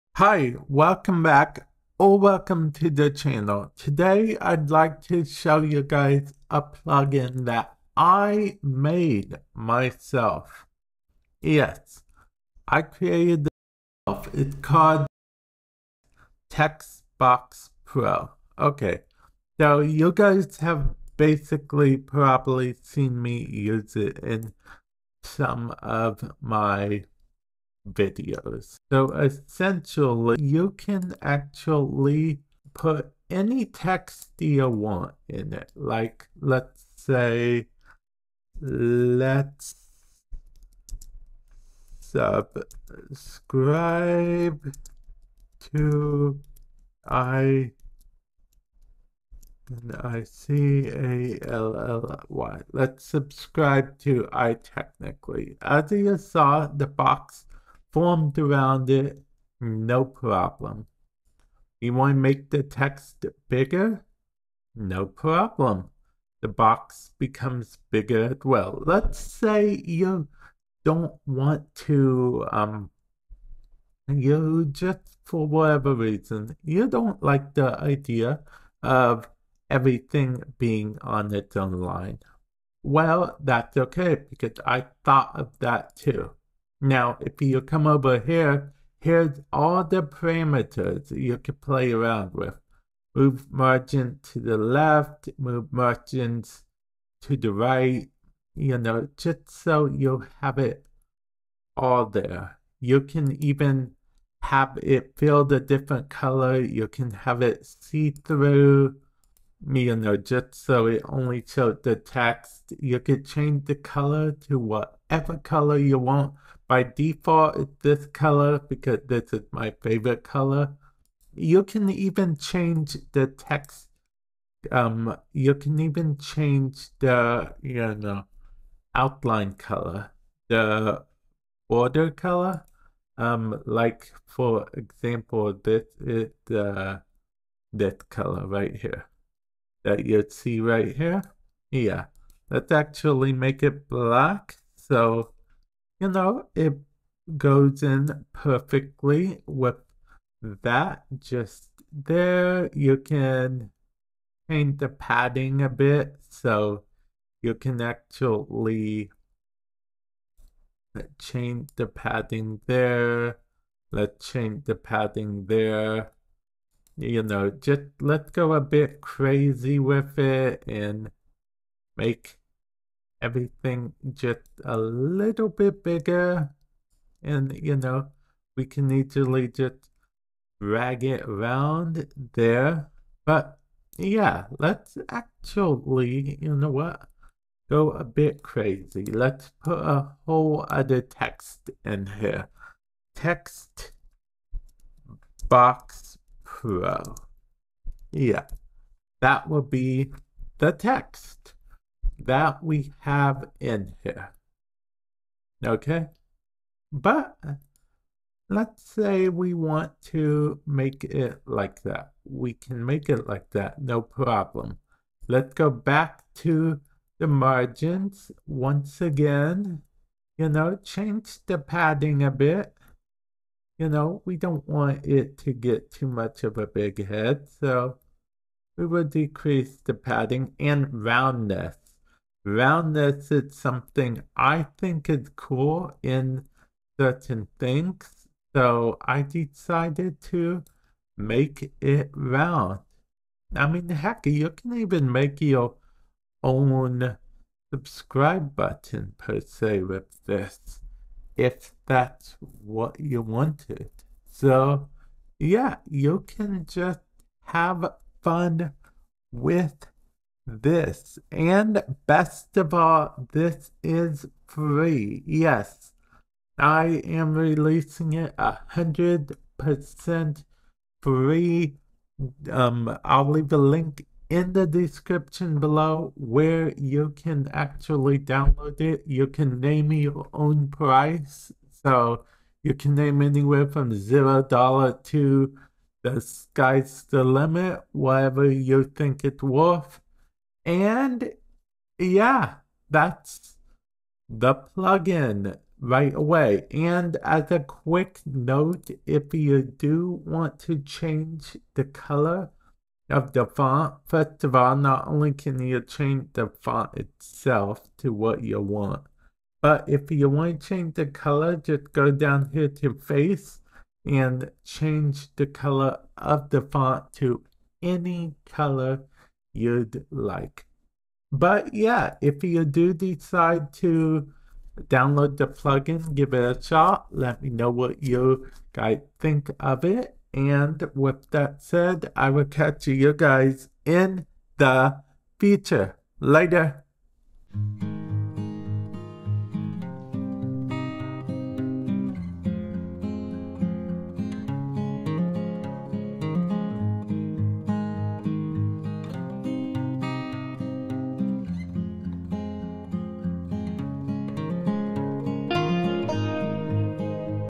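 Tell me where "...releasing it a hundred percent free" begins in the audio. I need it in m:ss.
4:27.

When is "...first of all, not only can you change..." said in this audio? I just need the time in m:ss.
5:04.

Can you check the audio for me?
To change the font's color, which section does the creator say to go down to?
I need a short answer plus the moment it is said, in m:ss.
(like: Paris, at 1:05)
Face, at 5:12.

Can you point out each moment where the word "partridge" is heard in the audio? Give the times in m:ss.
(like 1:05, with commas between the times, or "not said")
not said.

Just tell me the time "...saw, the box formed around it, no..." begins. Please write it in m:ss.
0:56.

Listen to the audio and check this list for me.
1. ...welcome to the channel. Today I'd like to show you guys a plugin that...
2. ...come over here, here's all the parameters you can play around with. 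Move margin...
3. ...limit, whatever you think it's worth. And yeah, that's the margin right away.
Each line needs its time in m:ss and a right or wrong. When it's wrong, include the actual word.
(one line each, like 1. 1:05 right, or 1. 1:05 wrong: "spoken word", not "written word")
1. 0:02 right
2. 1:27 right
3. 4:47 wrong: "plugin", not "margin".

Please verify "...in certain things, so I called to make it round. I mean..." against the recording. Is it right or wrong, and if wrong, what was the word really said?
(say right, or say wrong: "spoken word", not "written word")
wrong: "decided", not "called".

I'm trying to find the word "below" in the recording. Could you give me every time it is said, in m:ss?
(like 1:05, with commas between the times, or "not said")
4:35.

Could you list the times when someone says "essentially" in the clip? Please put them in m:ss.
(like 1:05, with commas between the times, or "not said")
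0:29.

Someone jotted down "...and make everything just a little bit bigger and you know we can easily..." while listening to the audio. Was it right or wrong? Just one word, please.
right.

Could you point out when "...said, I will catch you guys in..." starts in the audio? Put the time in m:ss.
5:31.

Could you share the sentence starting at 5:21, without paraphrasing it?
But yeah, if you do decide to download the plugin, give it a shot.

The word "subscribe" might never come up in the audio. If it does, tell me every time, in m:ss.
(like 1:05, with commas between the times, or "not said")
0:41, 0:53, 4:07.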